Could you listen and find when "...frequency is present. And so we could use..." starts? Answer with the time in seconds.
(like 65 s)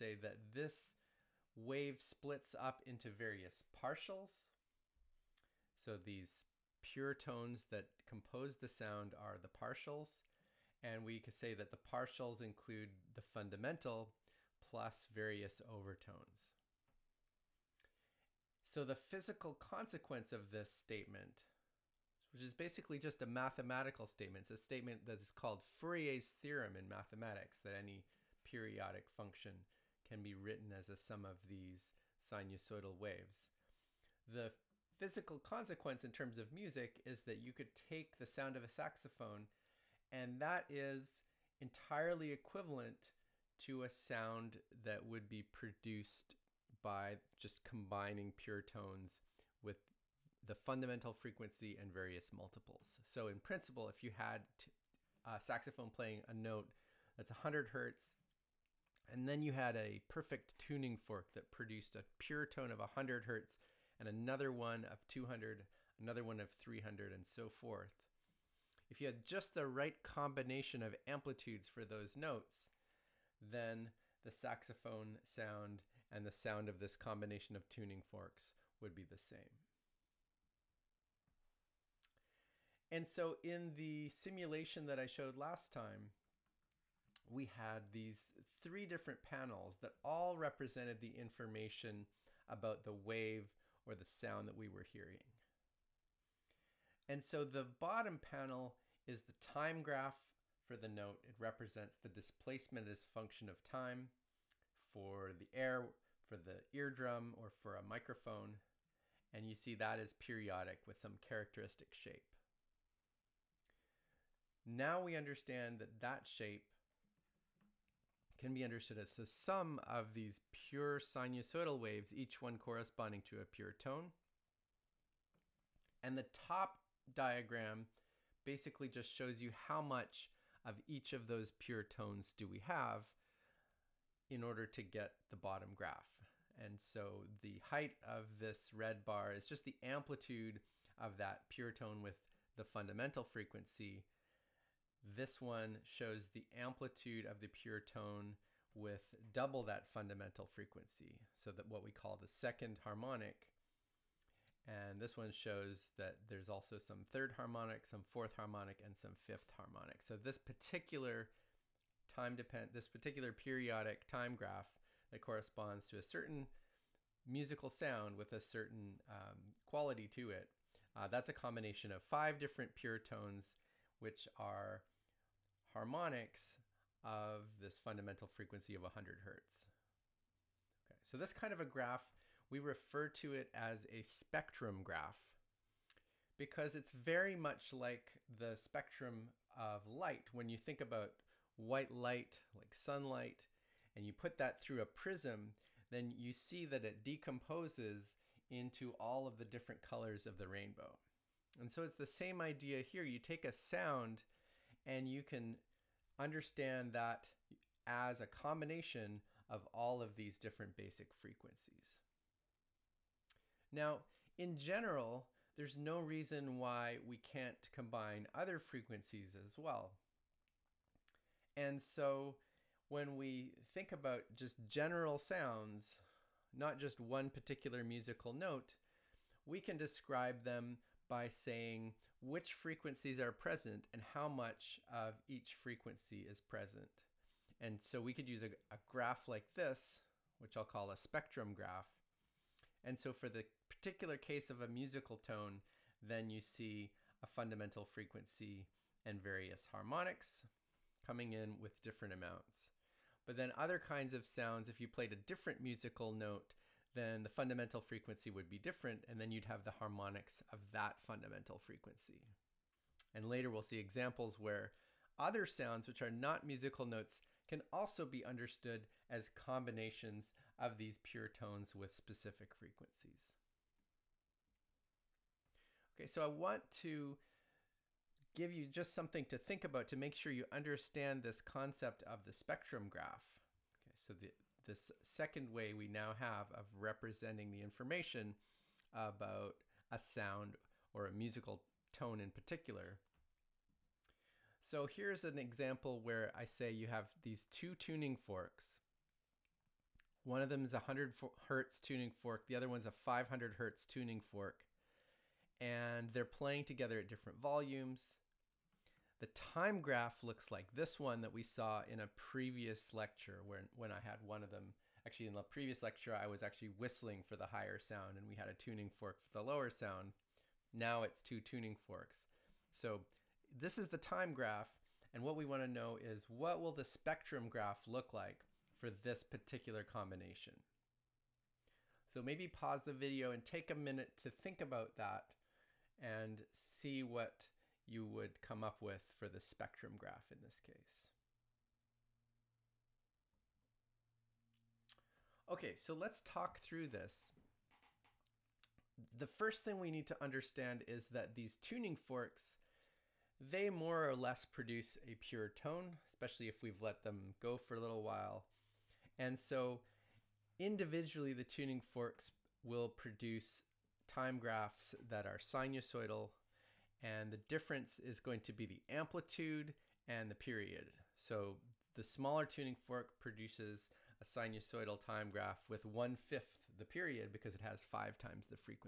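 235 s.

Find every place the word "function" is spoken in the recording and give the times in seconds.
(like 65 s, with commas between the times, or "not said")
29 s, 103 s.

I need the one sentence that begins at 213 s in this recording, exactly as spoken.
Now, in general, there's no reason why we can't combine other frequencies as well.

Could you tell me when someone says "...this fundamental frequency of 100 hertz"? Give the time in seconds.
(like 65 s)
177 s.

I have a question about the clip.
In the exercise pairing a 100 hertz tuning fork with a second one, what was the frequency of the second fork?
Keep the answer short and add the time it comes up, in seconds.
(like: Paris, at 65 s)
500 hertz, at 302 s.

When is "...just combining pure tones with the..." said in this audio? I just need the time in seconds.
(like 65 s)
47 s.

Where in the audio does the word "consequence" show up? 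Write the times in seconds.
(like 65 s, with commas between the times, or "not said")
19 s, 35 s.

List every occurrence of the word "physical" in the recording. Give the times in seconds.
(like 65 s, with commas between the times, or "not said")
18 s, 34 s.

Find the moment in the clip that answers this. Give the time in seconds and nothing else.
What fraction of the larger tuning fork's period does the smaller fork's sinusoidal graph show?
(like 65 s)
375 s.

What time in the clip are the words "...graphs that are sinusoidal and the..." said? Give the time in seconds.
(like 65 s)
364 s.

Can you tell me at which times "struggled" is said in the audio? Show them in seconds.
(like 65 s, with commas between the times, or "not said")
not said.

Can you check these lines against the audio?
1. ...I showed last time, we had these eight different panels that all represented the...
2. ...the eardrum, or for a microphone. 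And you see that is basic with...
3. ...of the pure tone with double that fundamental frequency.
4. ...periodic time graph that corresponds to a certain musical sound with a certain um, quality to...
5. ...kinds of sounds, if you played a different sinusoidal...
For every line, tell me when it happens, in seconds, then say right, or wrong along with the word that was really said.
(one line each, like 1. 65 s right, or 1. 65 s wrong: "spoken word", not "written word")
1. 84 s wrong: "three", not "eight"
2. 106 s wrong: "periodic", not "basic"
3. 147 s right
4. 163 s right
5. 253 s wrong: "musical", not "sinusoidal".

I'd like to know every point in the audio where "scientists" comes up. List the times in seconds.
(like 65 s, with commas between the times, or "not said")
not said.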